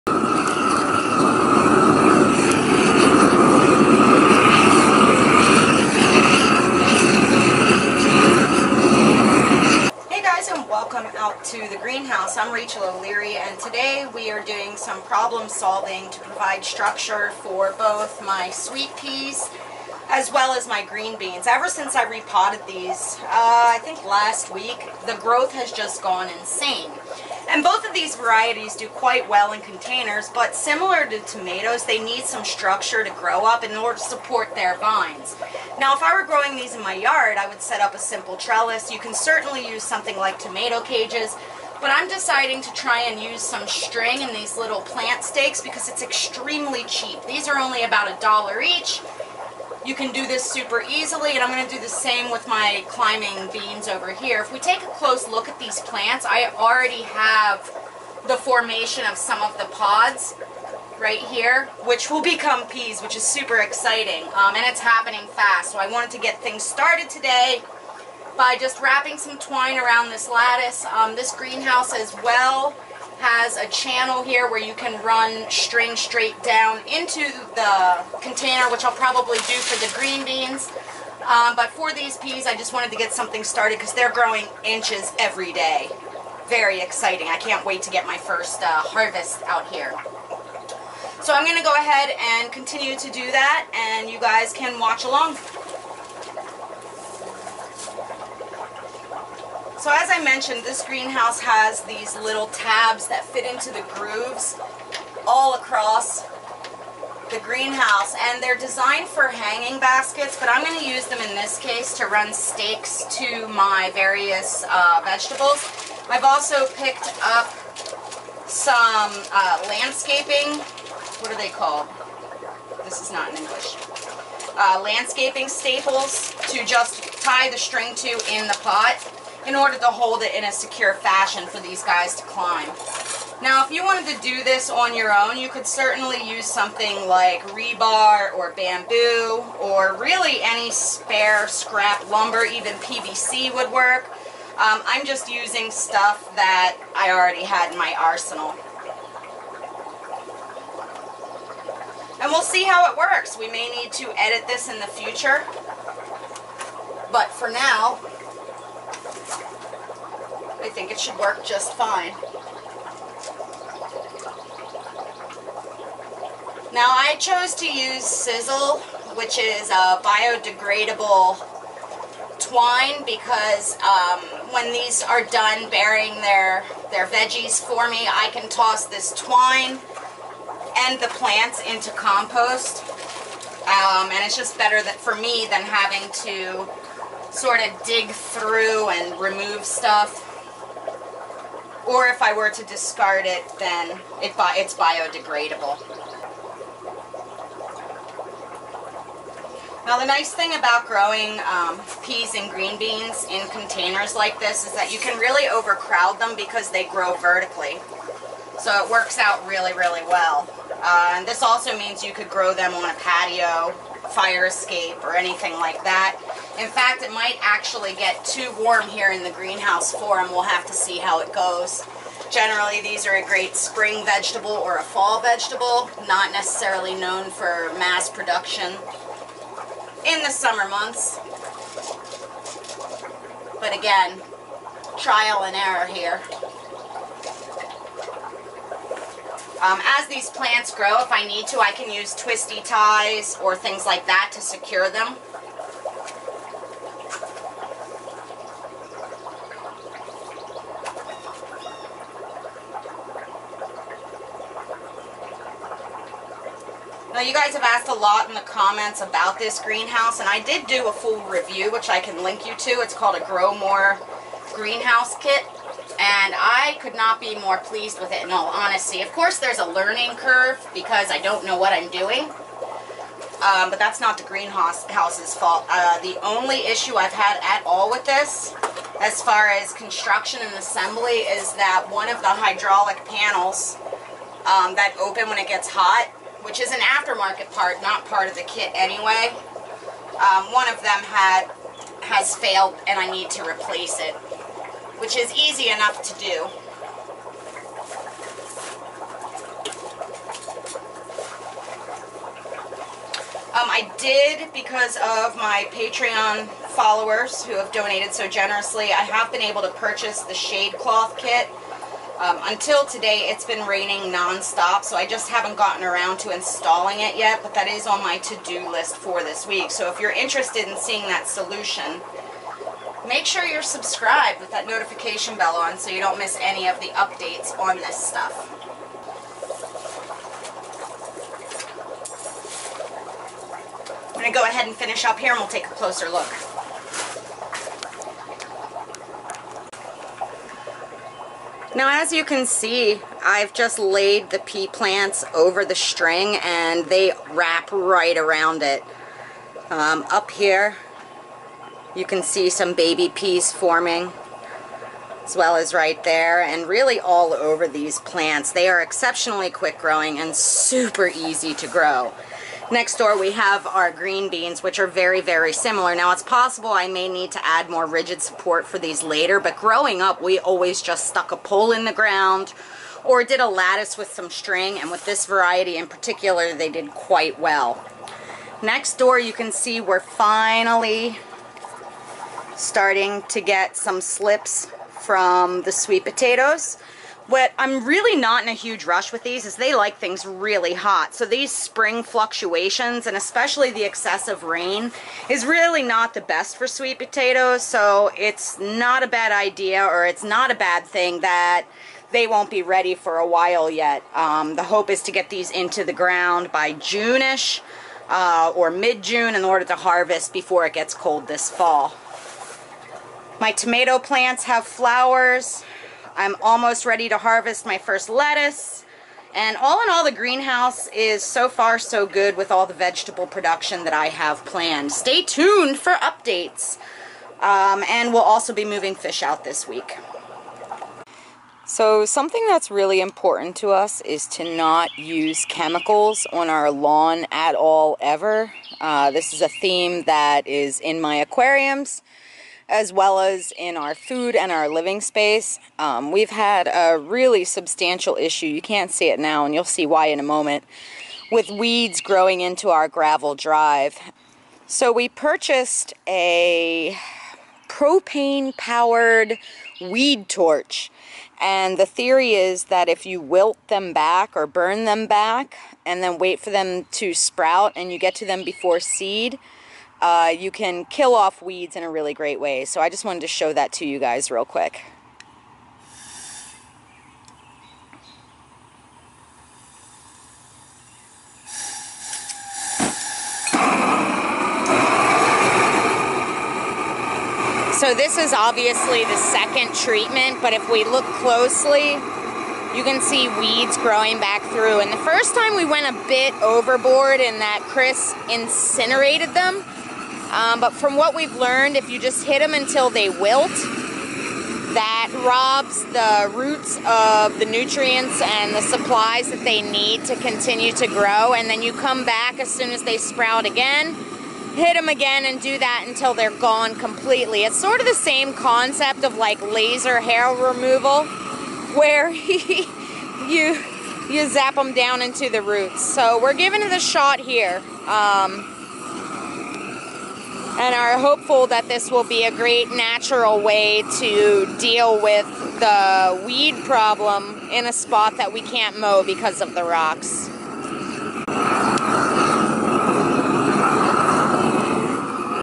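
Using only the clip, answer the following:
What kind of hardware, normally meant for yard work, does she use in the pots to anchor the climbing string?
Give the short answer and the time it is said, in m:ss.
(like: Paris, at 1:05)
landscaping staples, at 2:04.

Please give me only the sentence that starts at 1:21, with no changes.
Um, but for these peas, I just wanted to get something started because they're growing inches every day.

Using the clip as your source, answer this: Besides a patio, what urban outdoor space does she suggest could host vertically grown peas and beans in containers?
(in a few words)
fire escape.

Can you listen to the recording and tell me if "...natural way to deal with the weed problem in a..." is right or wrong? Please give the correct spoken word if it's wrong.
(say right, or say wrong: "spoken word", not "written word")
right.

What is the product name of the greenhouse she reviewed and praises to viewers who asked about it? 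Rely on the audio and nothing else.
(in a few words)
Grow More Greenhouse Kit.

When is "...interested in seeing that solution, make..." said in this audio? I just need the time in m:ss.
5:20.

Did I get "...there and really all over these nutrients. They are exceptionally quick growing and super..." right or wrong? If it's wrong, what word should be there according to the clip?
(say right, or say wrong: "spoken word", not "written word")
wrong: "plants", not "nutrients".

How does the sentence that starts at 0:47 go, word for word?
These are only about a dollar each.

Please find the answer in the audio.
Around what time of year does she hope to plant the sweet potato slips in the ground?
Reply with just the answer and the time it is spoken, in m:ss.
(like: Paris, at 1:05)
mid-June, at 6:48.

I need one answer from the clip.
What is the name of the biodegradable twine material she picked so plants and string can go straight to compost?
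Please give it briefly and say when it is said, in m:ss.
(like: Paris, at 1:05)
Sisal, at 2:48.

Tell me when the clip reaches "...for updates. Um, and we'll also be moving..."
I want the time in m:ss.
7:05.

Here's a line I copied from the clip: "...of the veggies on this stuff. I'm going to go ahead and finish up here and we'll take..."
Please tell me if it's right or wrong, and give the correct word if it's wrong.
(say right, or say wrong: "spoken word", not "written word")
wrong: "updates", not "veggies".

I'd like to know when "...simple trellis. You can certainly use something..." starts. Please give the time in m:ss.
0:37.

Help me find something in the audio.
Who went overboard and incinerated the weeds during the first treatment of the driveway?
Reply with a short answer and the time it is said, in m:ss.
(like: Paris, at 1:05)
Chris, at 8:17.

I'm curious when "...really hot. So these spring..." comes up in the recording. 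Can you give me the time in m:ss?
6:30.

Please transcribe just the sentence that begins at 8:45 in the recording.
So we're giving it a shot here.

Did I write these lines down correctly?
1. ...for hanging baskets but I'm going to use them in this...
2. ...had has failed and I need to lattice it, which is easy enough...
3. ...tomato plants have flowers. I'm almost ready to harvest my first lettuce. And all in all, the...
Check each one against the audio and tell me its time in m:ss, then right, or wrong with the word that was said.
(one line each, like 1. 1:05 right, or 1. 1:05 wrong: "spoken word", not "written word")
1. 1:49 right
2. 4:51 wrong: "replace", not "lattice"
3. 6:53 right.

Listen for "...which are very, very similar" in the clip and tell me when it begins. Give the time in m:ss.
6:04.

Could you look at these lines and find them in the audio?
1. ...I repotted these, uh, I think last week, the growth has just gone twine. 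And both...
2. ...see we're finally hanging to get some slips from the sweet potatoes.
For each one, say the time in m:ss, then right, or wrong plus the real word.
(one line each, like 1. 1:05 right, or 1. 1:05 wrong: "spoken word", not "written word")
1. 0:21 wrong: "insane", not "twine"
2. 6:19 wrong: "starting", not "hanging".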